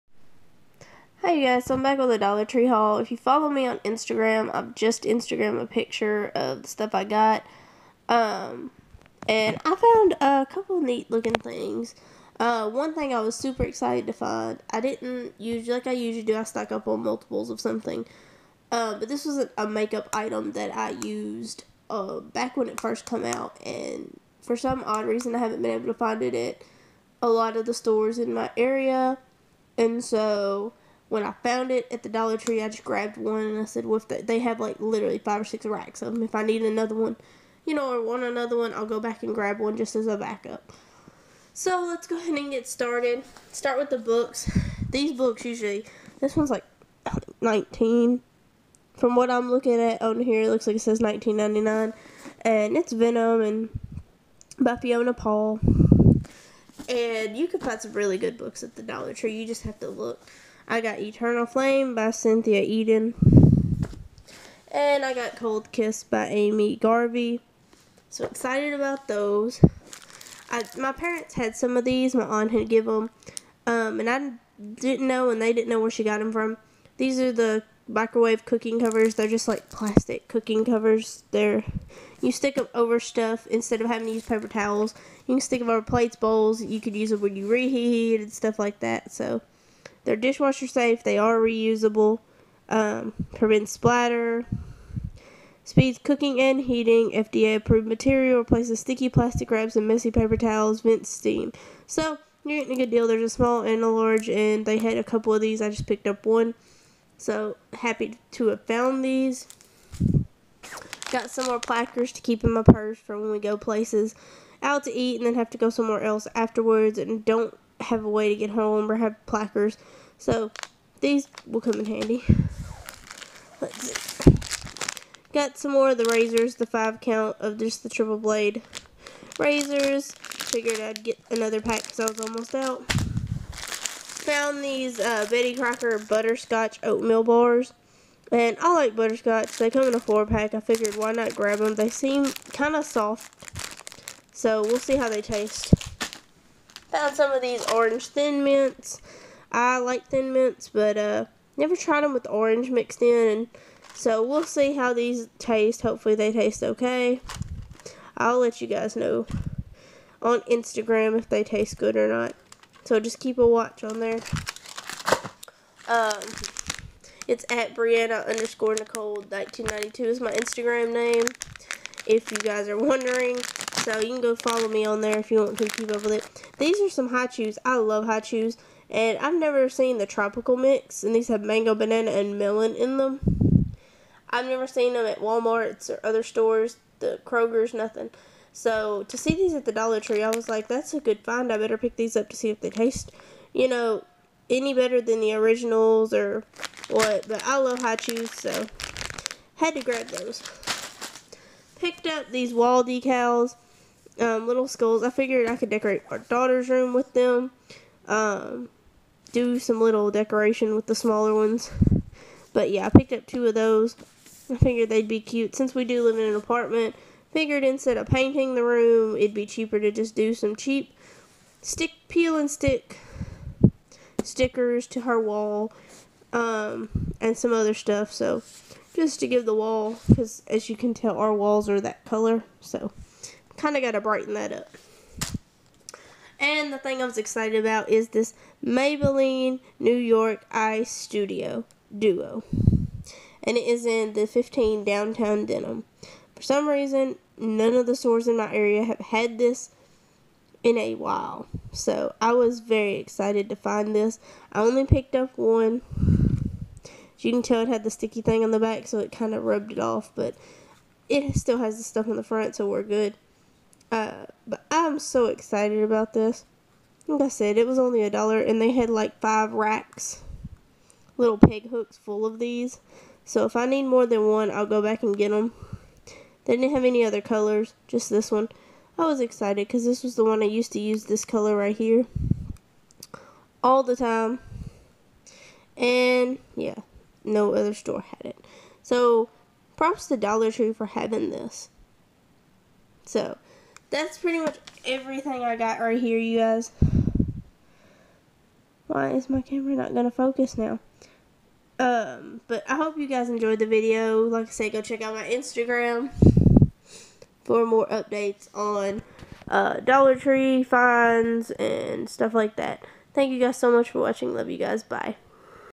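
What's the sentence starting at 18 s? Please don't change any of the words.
Uh, but this was a, makeup item that I used uh, back when it first come out.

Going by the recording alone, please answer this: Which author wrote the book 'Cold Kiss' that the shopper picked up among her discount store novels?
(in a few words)
Amy Garvey.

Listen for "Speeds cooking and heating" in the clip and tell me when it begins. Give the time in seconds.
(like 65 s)
95 s.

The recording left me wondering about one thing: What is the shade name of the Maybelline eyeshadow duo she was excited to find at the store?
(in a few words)
Downtown Denim.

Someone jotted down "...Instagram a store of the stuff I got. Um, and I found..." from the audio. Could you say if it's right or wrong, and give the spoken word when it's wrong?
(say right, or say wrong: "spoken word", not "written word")
wrong: "picture", not "store".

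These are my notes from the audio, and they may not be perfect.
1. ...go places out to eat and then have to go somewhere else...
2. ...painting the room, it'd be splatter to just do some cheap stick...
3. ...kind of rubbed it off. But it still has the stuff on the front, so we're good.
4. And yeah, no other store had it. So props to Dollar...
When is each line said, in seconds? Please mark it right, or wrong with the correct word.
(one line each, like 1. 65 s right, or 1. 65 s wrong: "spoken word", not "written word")
1. 113 s right
2. 218 s wrong: "cheaper", not "splatter"
3. 259 s right
4. 285 s right.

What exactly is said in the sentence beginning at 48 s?
From what I'm looking at on here, it looks like it says 1999.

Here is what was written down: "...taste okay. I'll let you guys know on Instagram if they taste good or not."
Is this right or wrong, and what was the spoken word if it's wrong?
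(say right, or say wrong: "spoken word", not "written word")
right.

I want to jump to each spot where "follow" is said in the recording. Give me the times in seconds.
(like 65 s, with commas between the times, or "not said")
3 s, 174 s.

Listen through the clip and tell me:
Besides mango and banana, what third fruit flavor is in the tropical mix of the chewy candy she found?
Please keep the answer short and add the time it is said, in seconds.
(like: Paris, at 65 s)
Melon, at 182 s.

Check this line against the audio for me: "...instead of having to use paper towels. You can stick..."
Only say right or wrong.
right.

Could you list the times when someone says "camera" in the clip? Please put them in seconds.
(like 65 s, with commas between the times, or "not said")
299 s.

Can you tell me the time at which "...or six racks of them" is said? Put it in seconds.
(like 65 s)
35 s.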